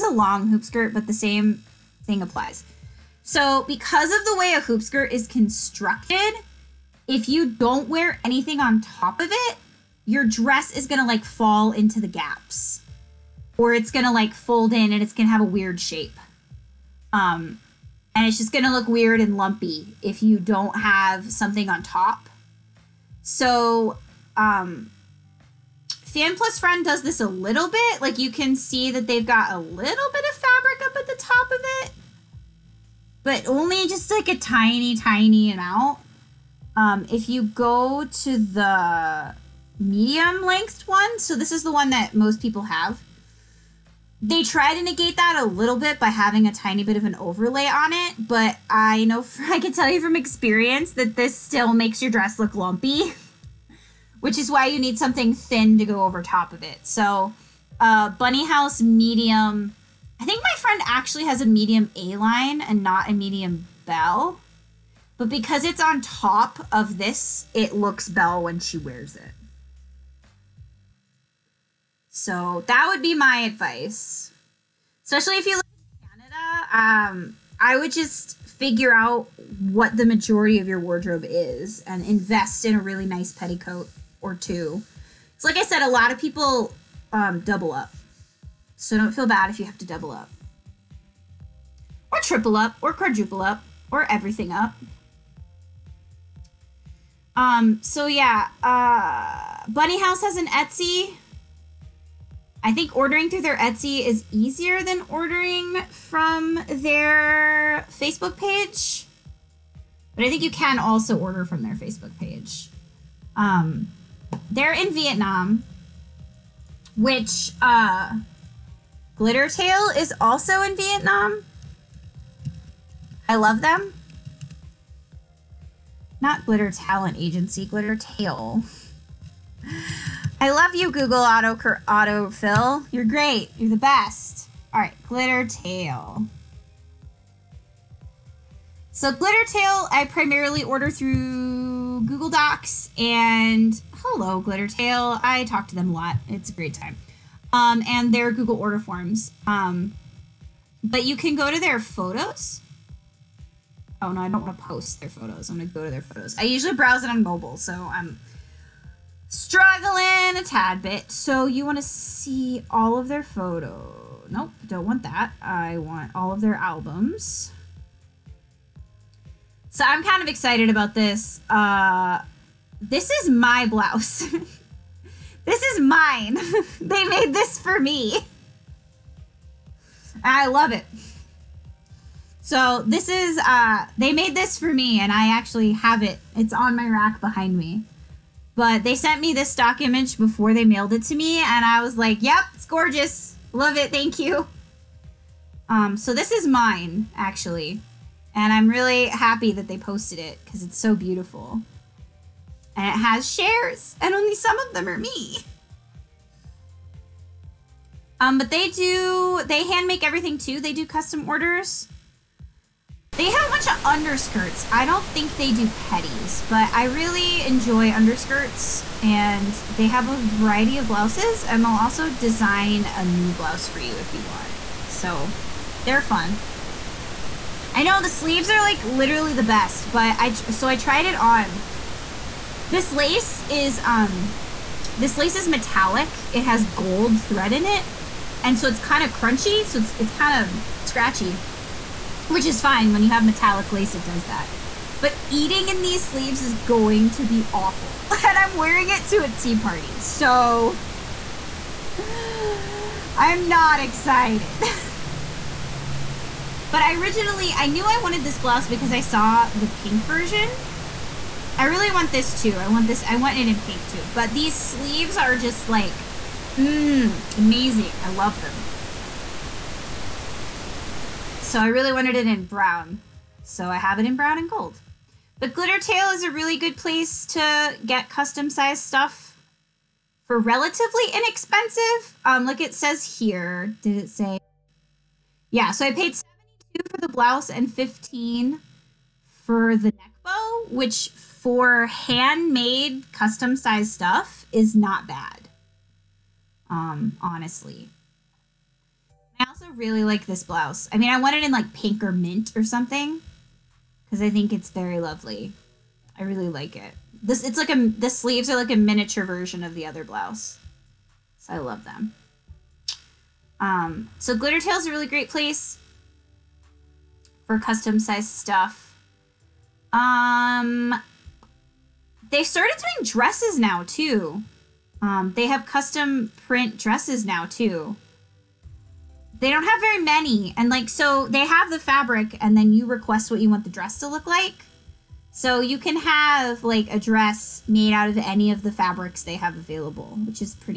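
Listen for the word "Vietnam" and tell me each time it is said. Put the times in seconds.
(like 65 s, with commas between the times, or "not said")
114 s, 120 s.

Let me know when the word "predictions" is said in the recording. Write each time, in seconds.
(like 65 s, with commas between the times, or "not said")
not said.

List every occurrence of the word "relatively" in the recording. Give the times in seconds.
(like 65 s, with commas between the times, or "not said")
280 s.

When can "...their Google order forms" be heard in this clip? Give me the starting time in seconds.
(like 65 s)
148 s.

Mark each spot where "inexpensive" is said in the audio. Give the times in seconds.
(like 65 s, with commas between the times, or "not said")
281 s.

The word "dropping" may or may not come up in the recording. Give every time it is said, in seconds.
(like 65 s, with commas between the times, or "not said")
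not said.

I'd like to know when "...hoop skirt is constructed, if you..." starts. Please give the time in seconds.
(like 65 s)
4 s.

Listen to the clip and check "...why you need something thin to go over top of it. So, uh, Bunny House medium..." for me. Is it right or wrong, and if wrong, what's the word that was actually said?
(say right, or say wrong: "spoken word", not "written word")
right.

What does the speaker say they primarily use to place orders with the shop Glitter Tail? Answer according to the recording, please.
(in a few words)
Google Docs.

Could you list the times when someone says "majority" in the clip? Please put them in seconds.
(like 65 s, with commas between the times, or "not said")
80 s.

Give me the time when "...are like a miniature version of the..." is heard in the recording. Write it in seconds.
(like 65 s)
308 s.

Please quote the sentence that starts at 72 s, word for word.
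So that would be my advice.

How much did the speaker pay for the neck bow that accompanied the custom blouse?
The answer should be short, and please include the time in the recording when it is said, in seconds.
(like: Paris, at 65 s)
15, at 287 s.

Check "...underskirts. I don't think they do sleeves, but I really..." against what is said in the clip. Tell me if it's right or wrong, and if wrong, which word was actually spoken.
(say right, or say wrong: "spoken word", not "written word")
wrong: "petties", not "sleeves".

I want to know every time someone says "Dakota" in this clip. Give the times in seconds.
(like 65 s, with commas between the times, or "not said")
not said.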